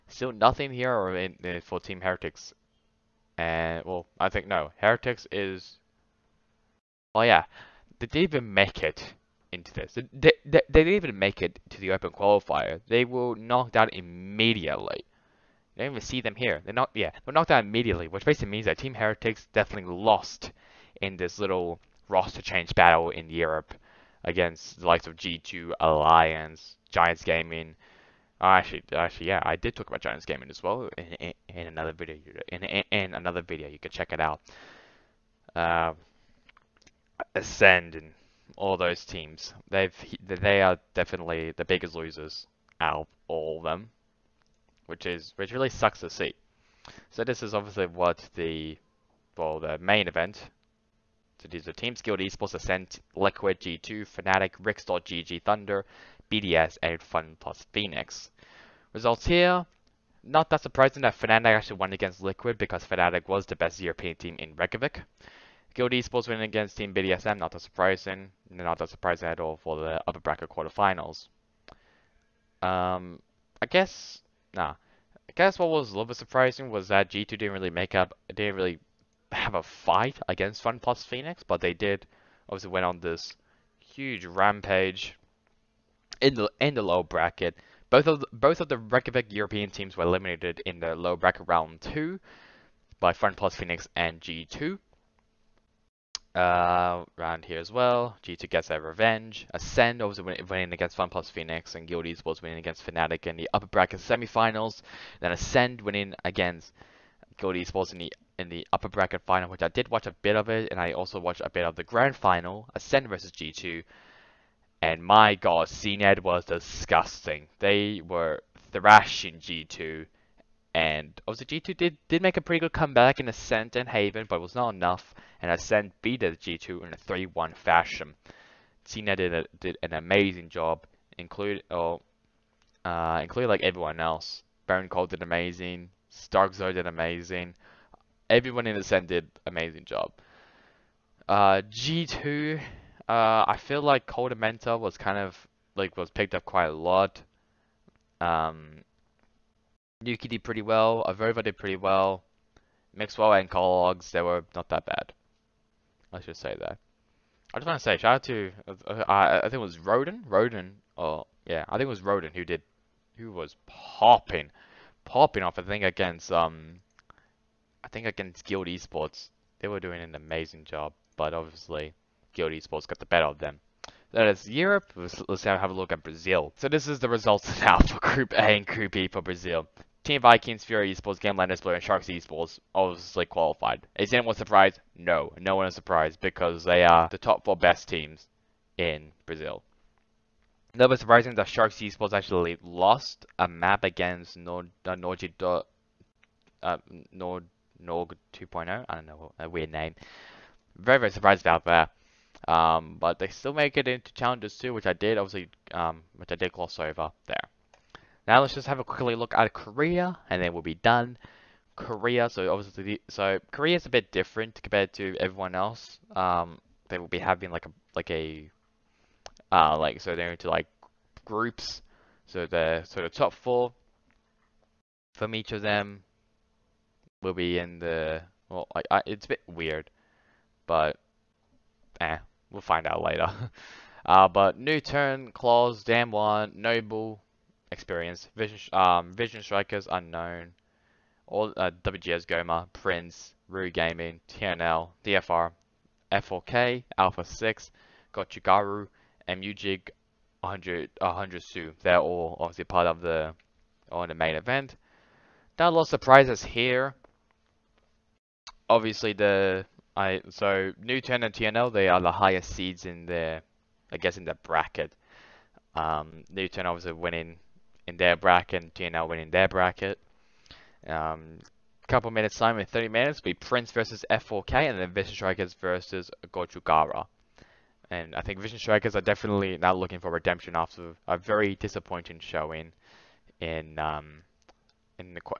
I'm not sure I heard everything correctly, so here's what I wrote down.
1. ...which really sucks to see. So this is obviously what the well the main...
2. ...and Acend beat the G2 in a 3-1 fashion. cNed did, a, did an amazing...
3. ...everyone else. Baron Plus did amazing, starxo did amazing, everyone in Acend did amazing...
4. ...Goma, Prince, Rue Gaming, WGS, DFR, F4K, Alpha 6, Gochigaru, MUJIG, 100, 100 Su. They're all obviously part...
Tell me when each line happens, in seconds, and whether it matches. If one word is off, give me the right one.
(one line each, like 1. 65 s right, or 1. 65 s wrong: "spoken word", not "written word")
1. 45 s right
2. 125 s right
3. 133 s wrong: "Cole", not "Plus"
4. 242 s wrong: "TNL", not "WGS".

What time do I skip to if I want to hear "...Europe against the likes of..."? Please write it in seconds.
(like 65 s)
23 s.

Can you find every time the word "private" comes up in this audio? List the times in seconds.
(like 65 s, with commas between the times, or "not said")
not said.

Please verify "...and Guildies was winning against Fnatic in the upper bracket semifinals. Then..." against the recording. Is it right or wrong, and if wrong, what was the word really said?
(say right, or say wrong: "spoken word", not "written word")
right.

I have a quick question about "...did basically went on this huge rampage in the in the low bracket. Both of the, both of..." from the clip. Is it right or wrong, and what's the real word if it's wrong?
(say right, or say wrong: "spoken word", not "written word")
wrong: "obviously", not "basically".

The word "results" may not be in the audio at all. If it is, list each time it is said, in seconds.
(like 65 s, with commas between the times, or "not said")
58 s, 177 s.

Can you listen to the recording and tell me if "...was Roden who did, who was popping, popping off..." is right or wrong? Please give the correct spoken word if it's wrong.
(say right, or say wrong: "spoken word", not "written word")
right.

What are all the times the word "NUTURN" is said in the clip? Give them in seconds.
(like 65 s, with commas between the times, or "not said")
234 s, 260 s, 266 s.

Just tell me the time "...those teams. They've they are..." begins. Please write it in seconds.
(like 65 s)
38 s.